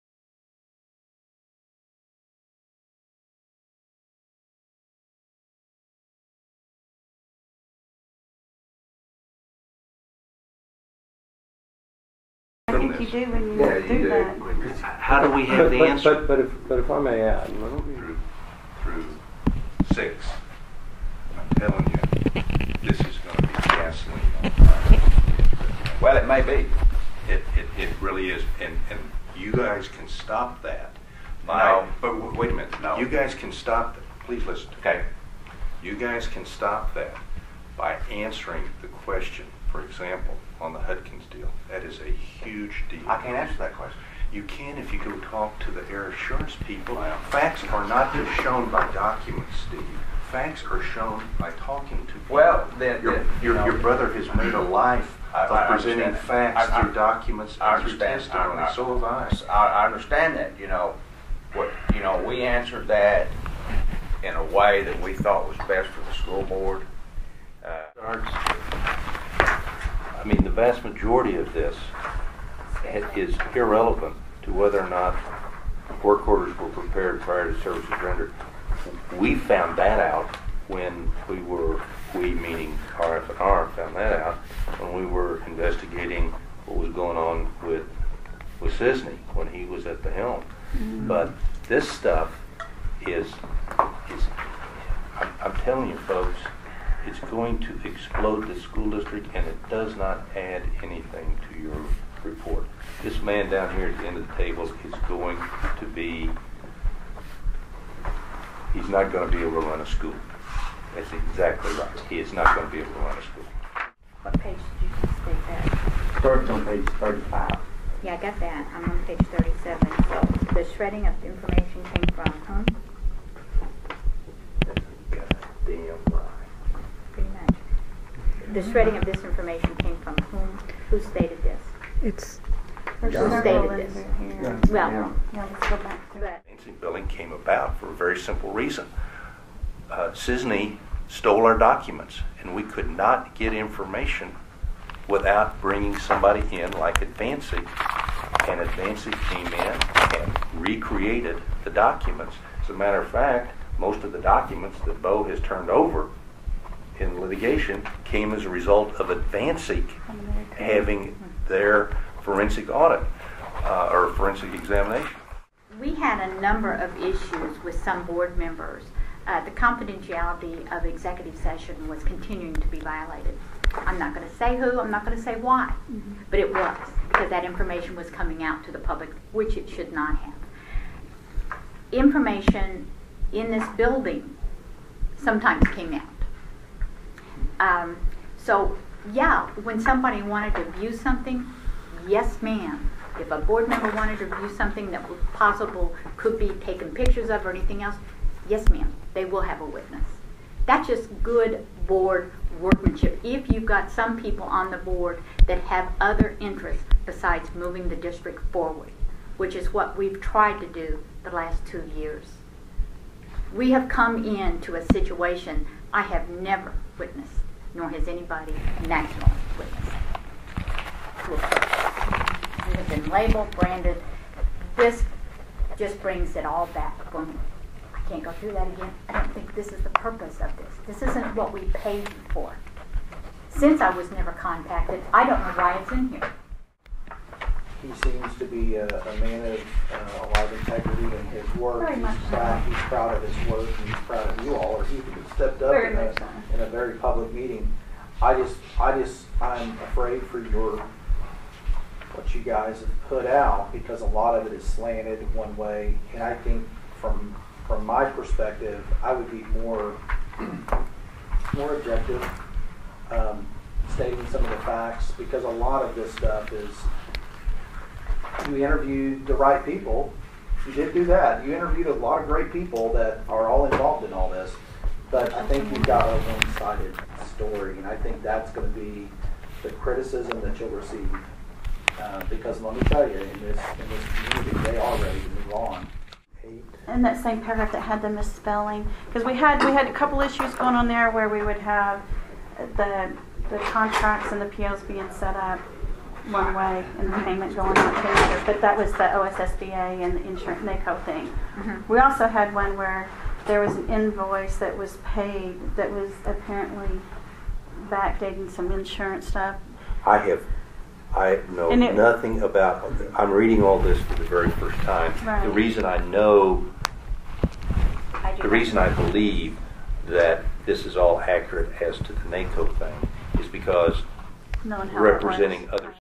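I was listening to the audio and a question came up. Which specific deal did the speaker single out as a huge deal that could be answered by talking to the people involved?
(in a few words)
Hudkins deal.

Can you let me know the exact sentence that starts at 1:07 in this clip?
Uh, I mean, the vast majority of this is irrelevant to whether or not work orders were prepared prior to services rendered.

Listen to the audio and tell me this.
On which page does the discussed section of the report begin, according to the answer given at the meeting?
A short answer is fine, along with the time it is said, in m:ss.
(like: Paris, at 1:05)
35, at 1:56.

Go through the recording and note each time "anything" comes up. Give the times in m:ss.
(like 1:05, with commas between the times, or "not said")
1:40, 3:17.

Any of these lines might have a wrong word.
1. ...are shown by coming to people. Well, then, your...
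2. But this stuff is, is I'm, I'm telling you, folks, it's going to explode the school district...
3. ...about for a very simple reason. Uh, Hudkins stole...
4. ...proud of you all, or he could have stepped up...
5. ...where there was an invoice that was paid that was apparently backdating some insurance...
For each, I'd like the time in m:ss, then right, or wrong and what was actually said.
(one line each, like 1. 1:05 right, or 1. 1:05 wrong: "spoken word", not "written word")
1. 0:50 wrong: "talking", not "coming"
2. 1:31 right
3. 2:17 wrong: "Sisney", not "Hudkins"
4. 4:03 right
5. 5:02 right.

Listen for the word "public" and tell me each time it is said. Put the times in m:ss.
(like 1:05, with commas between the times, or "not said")
2:58, 4:06.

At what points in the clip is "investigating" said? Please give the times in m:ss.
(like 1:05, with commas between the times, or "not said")
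1:25.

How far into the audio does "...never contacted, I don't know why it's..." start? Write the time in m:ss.
3:54.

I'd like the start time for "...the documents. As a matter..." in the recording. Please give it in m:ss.
2:31.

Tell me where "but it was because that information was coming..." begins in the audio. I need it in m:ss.
2:56.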